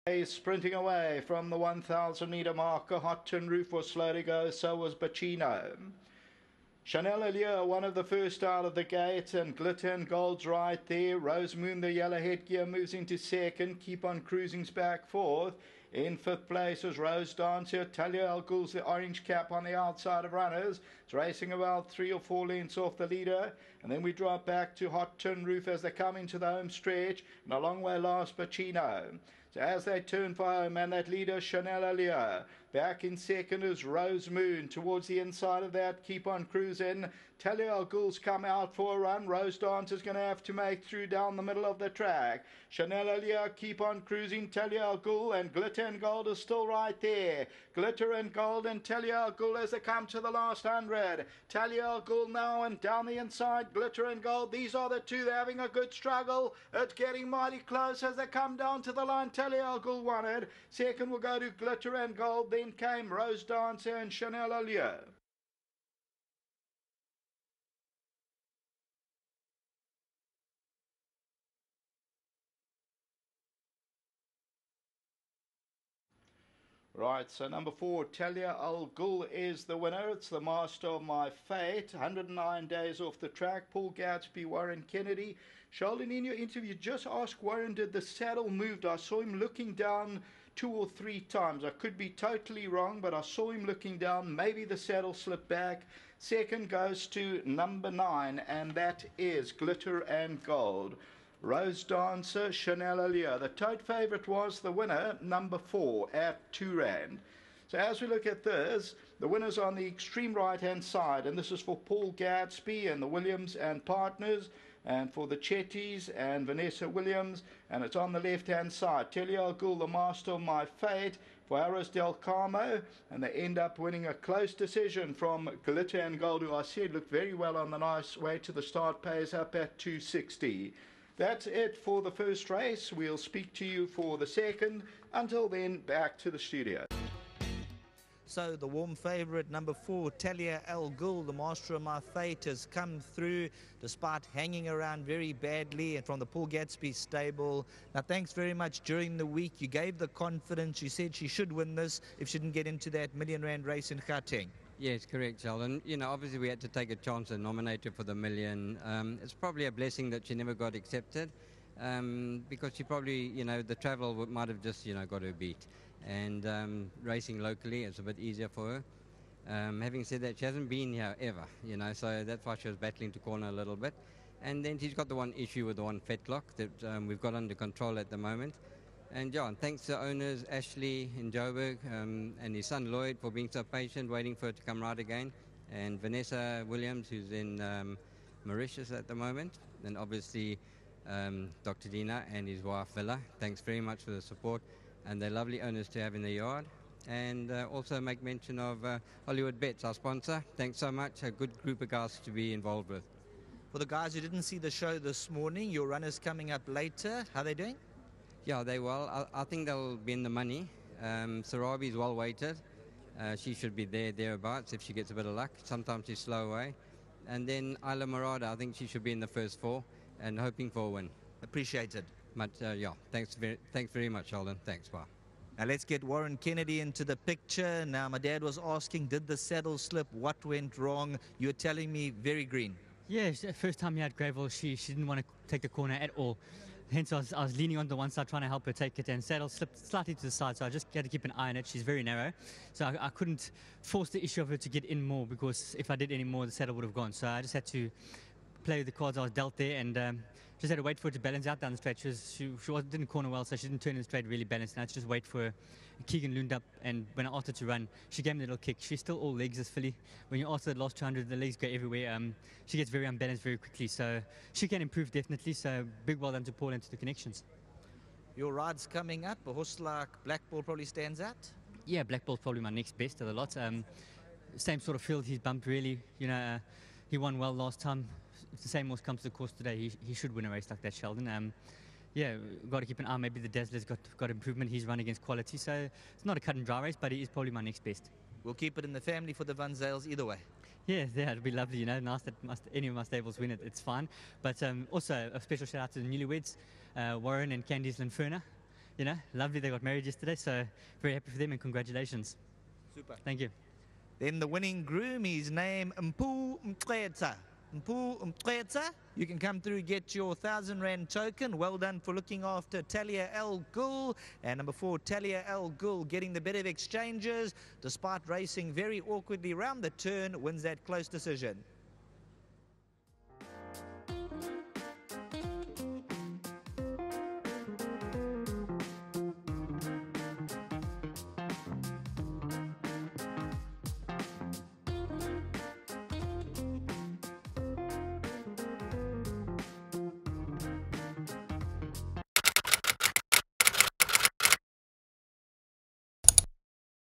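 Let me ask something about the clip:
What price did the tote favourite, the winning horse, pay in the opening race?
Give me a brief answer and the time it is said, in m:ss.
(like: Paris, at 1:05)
2 rand, at 1:46.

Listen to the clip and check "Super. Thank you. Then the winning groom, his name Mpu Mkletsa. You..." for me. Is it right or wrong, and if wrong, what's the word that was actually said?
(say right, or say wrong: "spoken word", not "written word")
right.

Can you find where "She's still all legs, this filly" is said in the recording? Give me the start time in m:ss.
4:18.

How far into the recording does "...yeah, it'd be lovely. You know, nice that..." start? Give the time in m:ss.
4:51.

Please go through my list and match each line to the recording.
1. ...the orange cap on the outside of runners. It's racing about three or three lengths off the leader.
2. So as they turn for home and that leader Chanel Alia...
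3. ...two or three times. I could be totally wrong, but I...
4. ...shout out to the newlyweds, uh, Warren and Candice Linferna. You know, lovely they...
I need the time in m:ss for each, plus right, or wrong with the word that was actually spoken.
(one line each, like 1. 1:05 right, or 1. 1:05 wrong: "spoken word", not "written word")
1. 0:18 wrong: "four", not "three"
2. 0:29 right
3. 1:30 right
4. 4:55 right.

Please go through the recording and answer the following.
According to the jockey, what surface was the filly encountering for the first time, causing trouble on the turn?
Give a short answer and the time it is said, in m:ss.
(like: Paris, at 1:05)
gravel, at 3:54.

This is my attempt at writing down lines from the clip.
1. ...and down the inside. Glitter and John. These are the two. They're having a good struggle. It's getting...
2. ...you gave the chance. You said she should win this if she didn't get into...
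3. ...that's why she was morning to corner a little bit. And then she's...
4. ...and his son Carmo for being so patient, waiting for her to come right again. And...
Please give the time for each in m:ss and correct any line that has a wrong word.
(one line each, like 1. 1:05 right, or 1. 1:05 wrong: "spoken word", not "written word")
1. 0:52 wrong: "Gold", not "John"
2. 2:29 wrong: "confidence", not "chance"
3. 2:52 wrong: "battling", not "morning"
4. 3:02 wrong: "Lloyd", not "Carmo".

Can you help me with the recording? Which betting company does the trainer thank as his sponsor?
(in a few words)
Hollywoodbets.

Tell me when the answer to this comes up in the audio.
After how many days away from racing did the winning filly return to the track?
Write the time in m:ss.
1:21.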